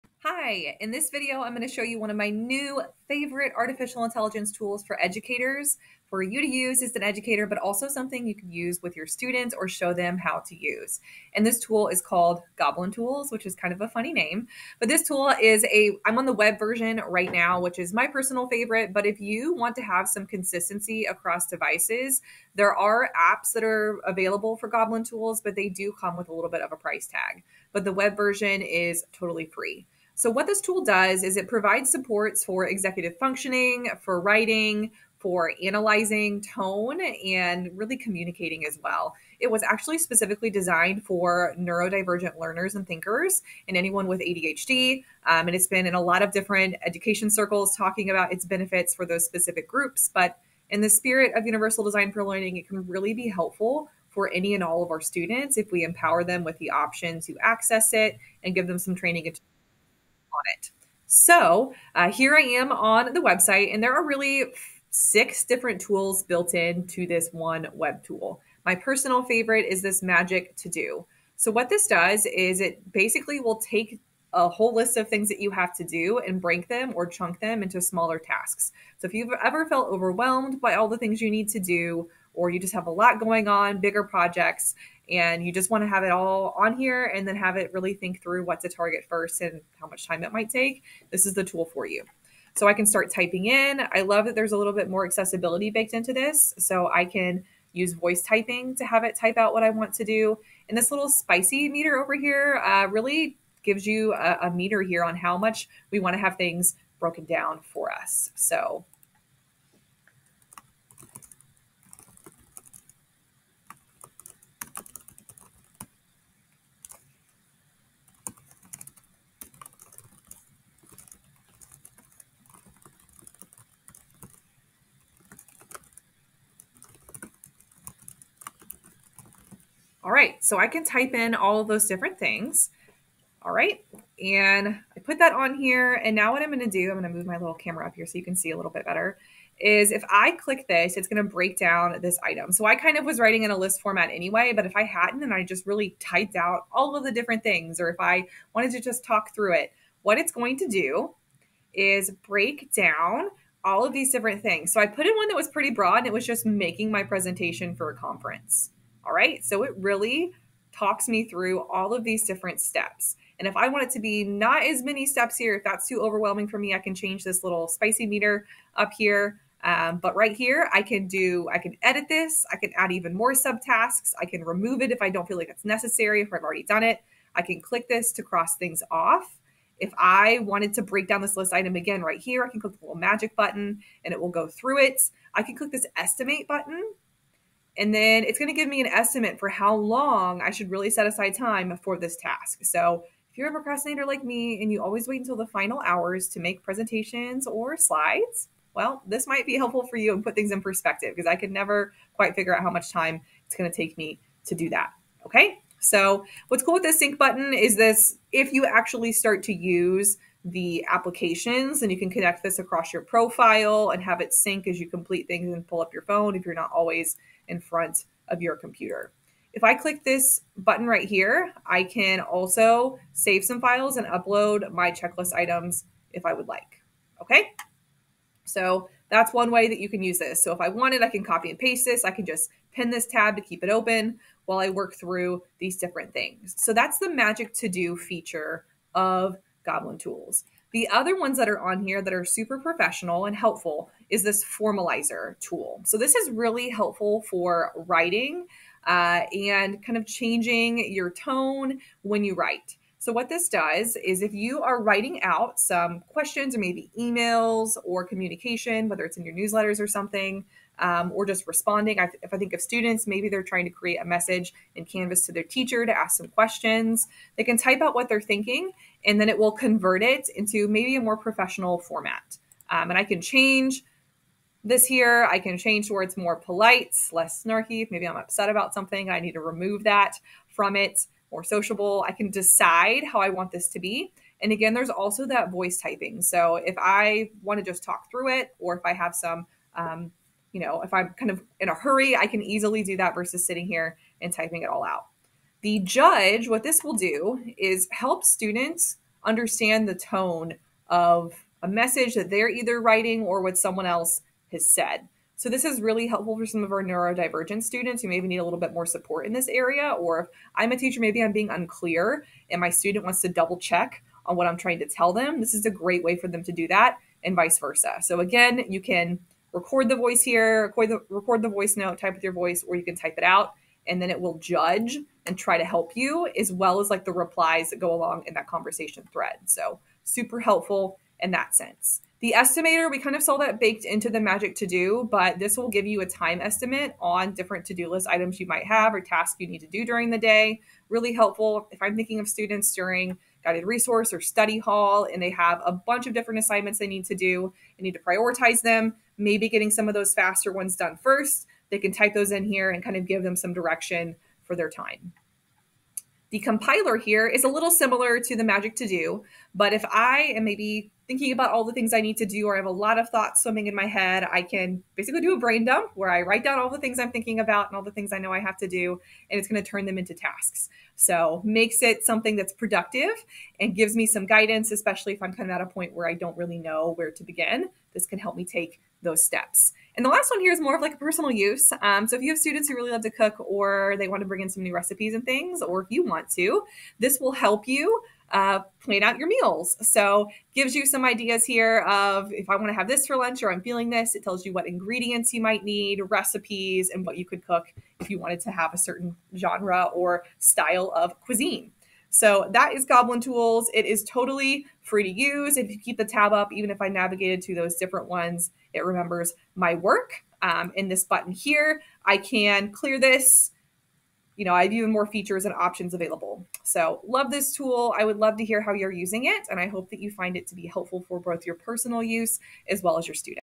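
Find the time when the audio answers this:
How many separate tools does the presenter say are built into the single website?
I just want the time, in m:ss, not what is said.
1:04.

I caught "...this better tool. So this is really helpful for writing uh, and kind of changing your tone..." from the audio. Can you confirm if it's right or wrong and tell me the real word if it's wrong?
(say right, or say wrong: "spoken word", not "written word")
wrong: "formalizer", not "better".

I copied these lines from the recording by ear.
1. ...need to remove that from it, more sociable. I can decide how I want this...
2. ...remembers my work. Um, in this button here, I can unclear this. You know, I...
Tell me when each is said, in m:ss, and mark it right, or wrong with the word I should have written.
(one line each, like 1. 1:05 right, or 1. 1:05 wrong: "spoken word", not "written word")
1. 4:39 right
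2. 6:48 wrong: "clear", not "unclear".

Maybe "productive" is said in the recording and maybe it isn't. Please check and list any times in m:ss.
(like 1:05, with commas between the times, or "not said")
6:12.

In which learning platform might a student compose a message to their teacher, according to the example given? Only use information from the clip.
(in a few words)
Canvas.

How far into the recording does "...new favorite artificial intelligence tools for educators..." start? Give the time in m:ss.
0:02.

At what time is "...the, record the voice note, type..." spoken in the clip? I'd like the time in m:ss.
5:20.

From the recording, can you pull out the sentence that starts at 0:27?
But the web version is totally free.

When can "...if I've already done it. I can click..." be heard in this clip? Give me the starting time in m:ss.
2:56.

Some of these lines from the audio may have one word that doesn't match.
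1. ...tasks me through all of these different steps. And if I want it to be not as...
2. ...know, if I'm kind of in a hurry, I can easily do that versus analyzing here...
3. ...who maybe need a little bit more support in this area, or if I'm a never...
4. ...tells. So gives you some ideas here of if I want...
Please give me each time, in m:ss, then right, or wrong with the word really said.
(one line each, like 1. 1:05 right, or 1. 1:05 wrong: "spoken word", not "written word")
1. 2:40 wrong: "talks", not "tasks"
2. 4:50 wrong: "sitting", not "analyzing"
3. 5:08 wrong: "teacher", not "never"
4. 6:29 wrong: "meals", not "tells".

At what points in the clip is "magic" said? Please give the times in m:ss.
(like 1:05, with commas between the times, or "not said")
1:10, 3:02, 3:57, 5:34, 5:58.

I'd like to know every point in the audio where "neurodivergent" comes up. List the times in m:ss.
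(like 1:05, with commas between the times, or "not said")
0:41, 5:06.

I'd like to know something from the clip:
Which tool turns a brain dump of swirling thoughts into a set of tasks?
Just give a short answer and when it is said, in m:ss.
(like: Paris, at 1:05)
compiler, at 5:56.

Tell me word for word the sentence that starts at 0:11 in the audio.
And this tool is called Goblin Tools, which is kind of a funny name.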